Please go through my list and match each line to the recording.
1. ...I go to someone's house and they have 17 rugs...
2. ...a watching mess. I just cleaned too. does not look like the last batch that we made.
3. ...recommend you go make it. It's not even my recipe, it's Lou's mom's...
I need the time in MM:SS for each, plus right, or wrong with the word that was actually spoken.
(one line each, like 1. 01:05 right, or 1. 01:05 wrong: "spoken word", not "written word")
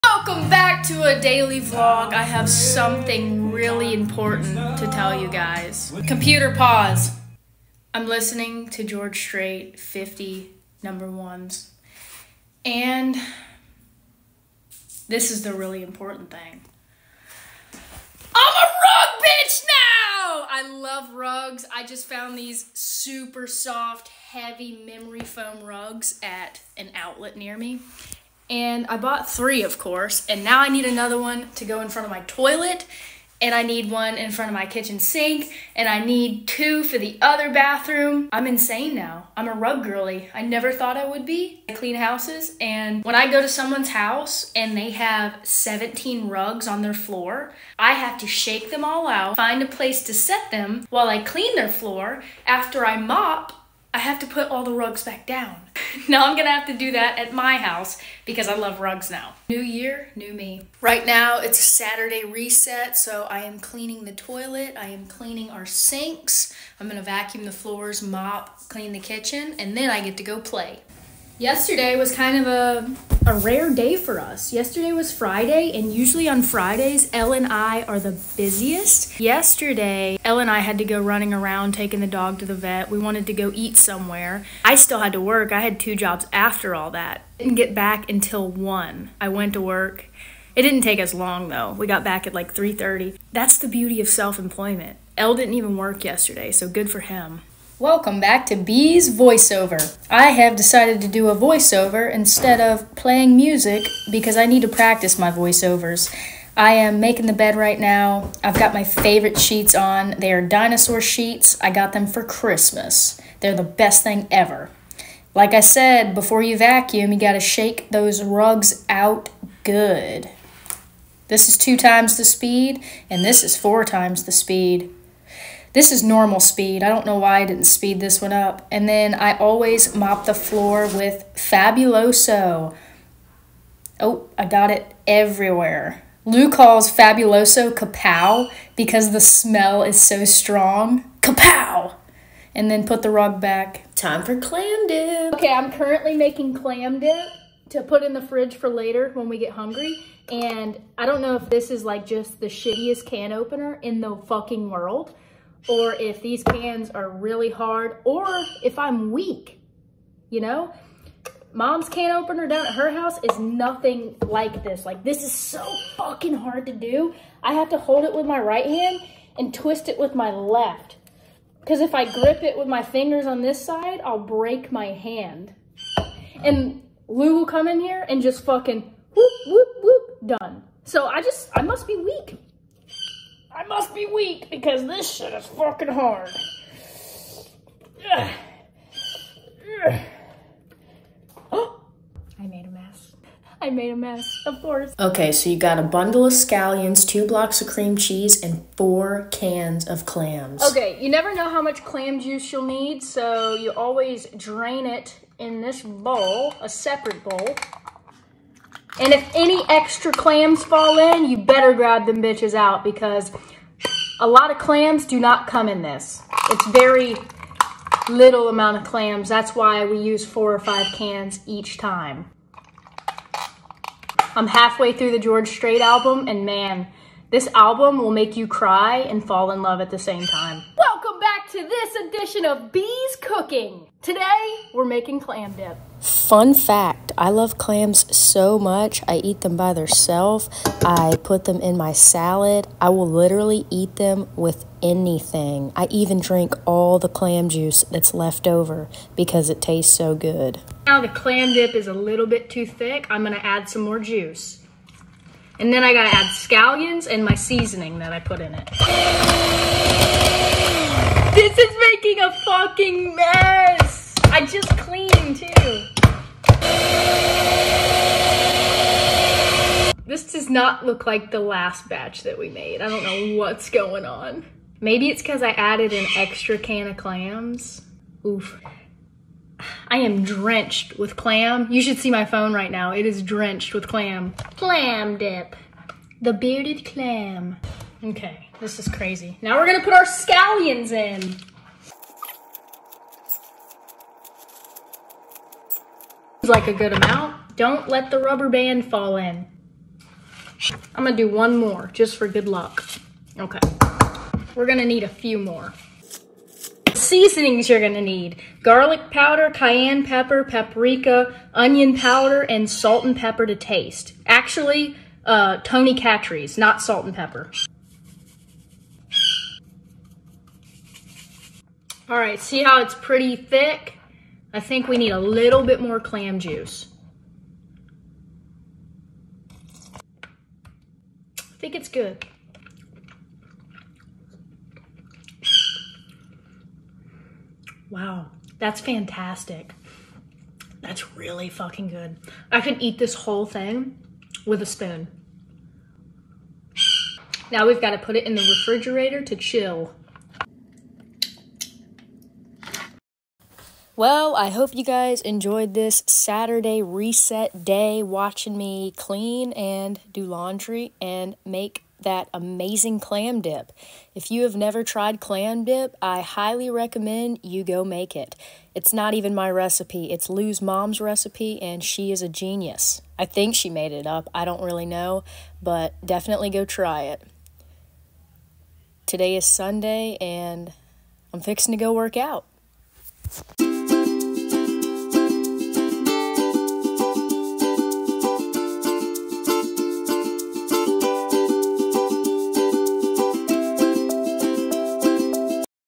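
1. 00:43 right
2. 04:22 wrong: "fucking", not "watching"
3. 06:06 right.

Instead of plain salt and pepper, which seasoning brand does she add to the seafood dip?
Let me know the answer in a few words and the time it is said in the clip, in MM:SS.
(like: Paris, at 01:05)
Tony Chachere's, at 05:15.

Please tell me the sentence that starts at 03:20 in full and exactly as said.
Okay, you never know how much clam juice you'll need, so you always drain it in this bowl, a separate bowl.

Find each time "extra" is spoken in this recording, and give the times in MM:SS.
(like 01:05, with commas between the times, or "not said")
03:29, 04:36.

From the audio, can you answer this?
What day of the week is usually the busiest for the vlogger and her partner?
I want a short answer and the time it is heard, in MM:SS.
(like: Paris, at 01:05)
Friday, at 01:16.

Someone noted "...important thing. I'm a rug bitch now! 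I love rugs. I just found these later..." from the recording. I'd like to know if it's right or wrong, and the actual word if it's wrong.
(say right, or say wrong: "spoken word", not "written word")
wrong: "super", not "later".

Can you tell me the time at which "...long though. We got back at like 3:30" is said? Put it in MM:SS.
01:31.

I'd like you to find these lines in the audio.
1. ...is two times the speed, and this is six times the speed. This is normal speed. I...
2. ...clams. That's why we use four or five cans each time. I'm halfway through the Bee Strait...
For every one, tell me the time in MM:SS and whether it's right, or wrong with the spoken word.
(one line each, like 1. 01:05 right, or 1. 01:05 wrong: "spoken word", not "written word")
1. 02:01 wrong: "four", not "six"
2. 03:38 wrong: "George", not "Bee".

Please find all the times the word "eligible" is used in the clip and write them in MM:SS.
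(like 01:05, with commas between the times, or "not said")
not said.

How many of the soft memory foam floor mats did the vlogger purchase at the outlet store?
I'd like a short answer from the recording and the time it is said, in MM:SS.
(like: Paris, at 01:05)
3, at 00:29.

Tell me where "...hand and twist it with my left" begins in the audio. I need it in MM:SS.
02:48.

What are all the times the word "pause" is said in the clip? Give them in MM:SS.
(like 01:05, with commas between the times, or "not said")
00:06.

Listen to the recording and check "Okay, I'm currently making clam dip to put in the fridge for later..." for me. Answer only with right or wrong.
right.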